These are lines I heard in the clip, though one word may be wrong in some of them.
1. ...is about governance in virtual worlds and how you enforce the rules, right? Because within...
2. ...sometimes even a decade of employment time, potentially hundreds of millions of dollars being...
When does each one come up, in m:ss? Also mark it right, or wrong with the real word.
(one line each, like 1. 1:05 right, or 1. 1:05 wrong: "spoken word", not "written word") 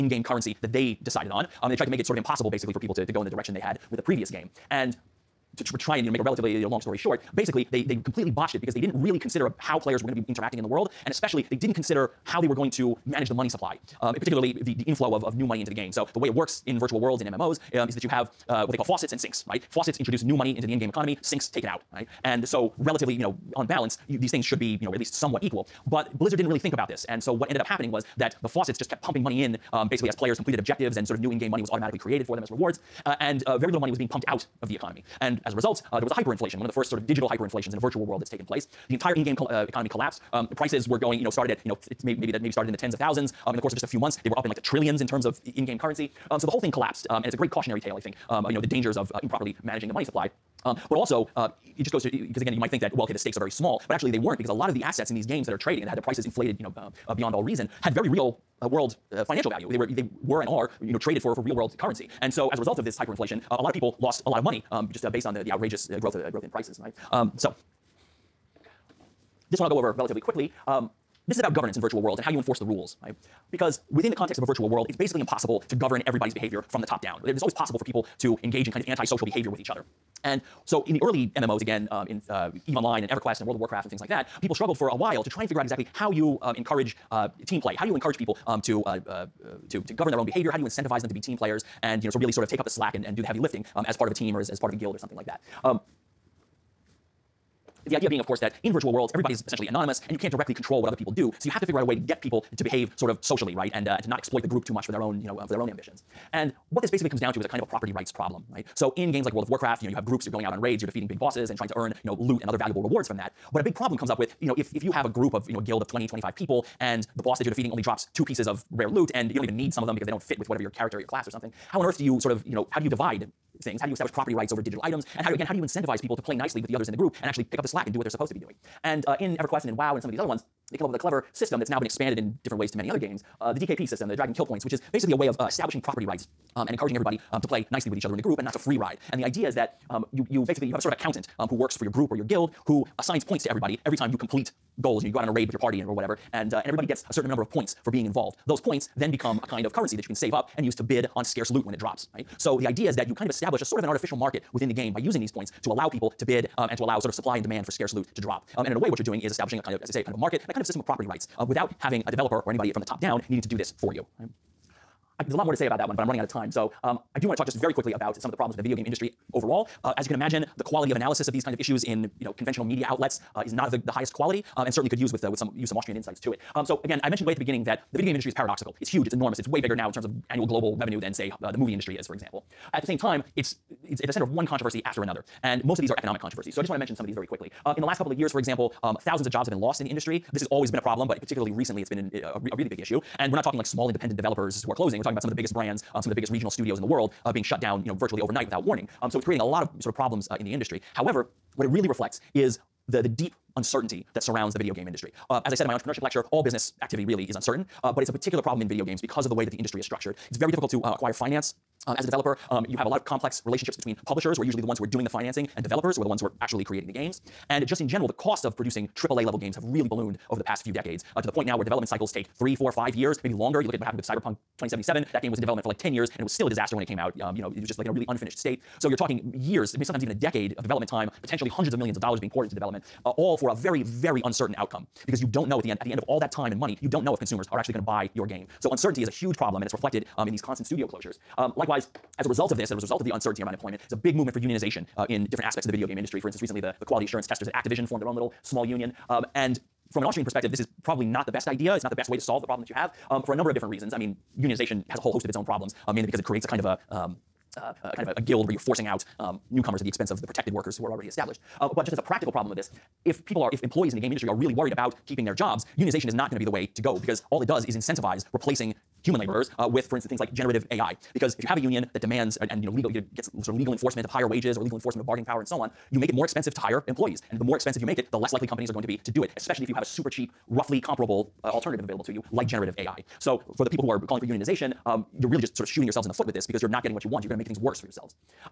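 1. 1:11 right
2. 3:49 wrong: "development", not "employment".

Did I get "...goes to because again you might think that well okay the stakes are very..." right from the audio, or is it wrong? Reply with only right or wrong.
right.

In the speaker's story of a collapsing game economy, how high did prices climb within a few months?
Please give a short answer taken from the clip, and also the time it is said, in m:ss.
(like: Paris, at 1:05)
trillions, at 0:44.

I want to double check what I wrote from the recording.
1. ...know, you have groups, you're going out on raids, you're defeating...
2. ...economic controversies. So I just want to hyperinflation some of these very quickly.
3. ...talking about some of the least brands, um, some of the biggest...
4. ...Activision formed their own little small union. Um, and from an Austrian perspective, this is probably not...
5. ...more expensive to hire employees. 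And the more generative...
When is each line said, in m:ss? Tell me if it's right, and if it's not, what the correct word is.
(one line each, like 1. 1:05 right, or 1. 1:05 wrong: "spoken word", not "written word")
1. 1:49 right
2. 3:05 wrong: "mention", not "hyperinflation"
3. 3:15 wrong: "biggest", not "least"
4. 4:07 right
5. 4:36 wrong: "expensive", not "generative".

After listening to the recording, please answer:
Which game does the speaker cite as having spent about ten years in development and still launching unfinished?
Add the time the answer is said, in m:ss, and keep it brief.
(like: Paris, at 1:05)
Cyberpunk 2077, at 3:44.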